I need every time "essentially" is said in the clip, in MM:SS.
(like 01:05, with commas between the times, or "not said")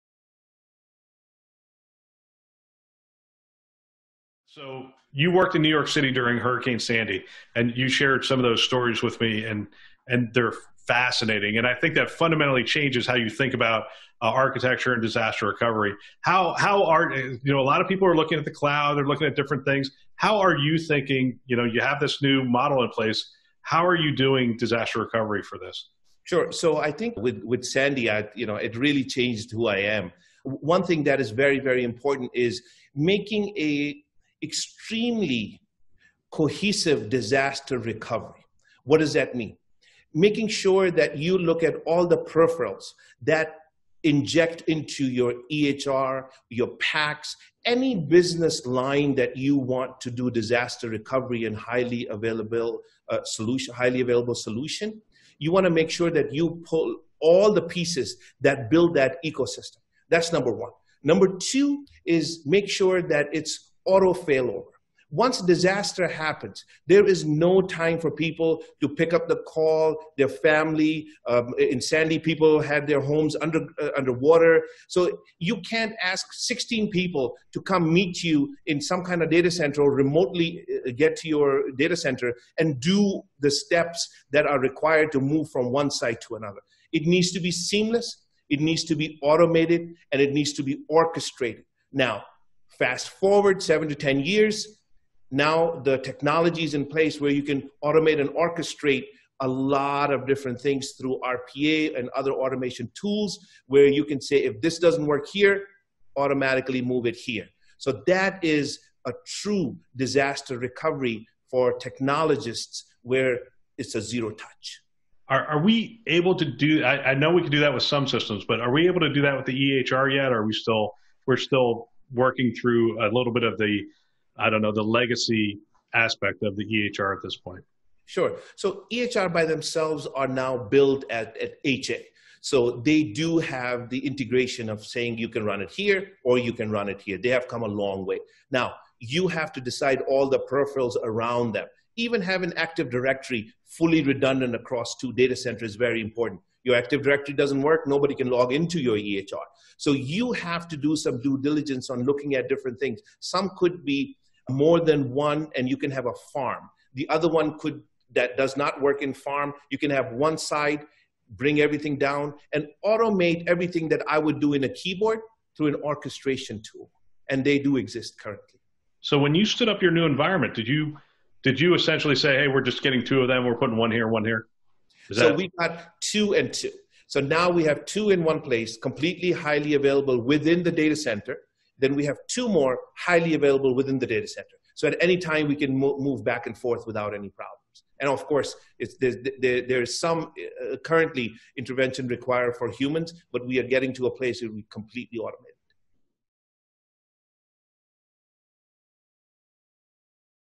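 02:51.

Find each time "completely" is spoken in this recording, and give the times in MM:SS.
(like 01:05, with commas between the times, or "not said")
02:58, 03:14.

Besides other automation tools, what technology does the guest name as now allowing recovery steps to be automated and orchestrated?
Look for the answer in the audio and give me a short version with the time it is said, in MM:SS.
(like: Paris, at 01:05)
RPA, at 01:41.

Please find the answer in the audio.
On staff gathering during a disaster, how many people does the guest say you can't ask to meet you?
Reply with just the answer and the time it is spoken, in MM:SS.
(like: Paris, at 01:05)
16, at 01:16.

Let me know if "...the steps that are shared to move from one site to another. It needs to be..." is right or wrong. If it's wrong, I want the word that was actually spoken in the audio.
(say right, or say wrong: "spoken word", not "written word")
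wrong: "required", not "shared".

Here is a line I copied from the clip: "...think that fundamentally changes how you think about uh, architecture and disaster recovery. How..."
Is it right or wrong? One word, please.
right.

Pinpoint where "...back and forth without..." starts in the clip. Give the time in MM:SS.
03:06.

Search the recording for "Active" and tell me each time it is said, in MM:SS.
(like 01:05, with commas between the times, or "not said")
02:22, 02:26.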